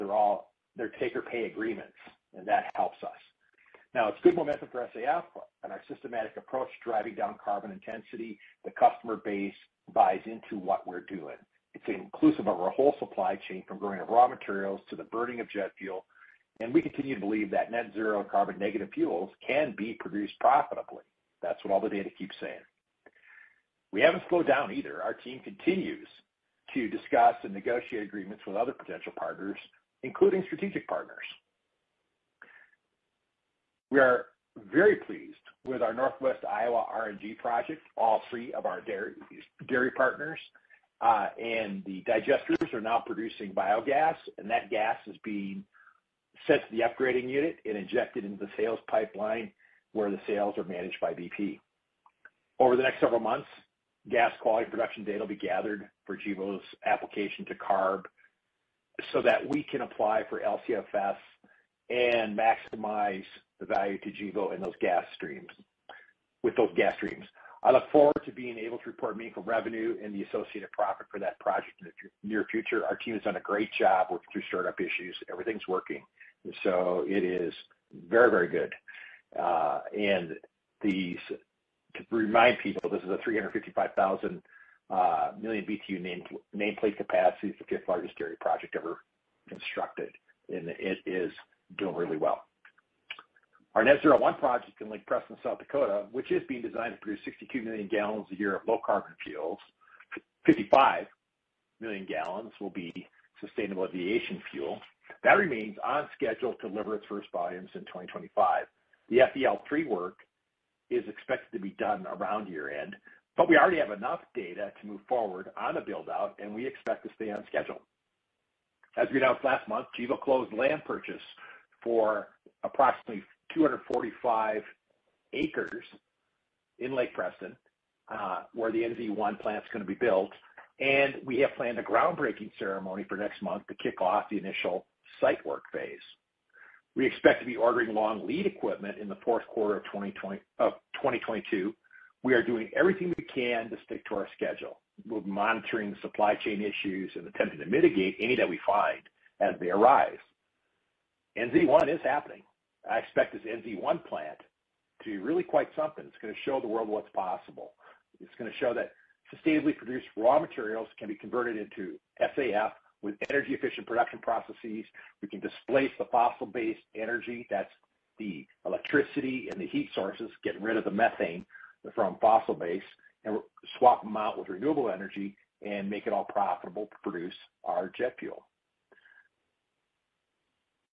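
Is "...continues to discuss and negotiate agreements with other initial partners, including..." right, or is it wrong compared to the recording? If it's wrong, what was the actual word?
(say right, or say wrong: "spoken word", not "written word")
wrong: "potential", not "initial".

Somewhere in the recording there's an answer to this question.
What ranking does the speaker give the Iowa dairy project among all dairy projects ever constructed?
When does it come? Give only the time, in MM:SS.
01:27.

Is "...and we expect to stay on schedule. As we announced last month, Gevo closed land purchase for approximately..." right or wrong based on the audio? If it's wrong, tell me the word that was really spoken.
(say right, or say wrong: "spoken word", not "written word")
right.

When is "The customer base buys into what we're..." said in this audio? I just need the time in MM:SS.
00:08.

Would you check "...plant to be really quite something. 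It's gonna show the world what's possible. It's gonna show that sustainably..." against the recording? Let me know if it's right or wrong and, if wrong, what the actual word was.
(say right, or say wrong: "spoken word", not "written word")
right.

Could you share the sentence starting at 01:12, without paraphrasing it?
Our team has done a great job working through startup issues.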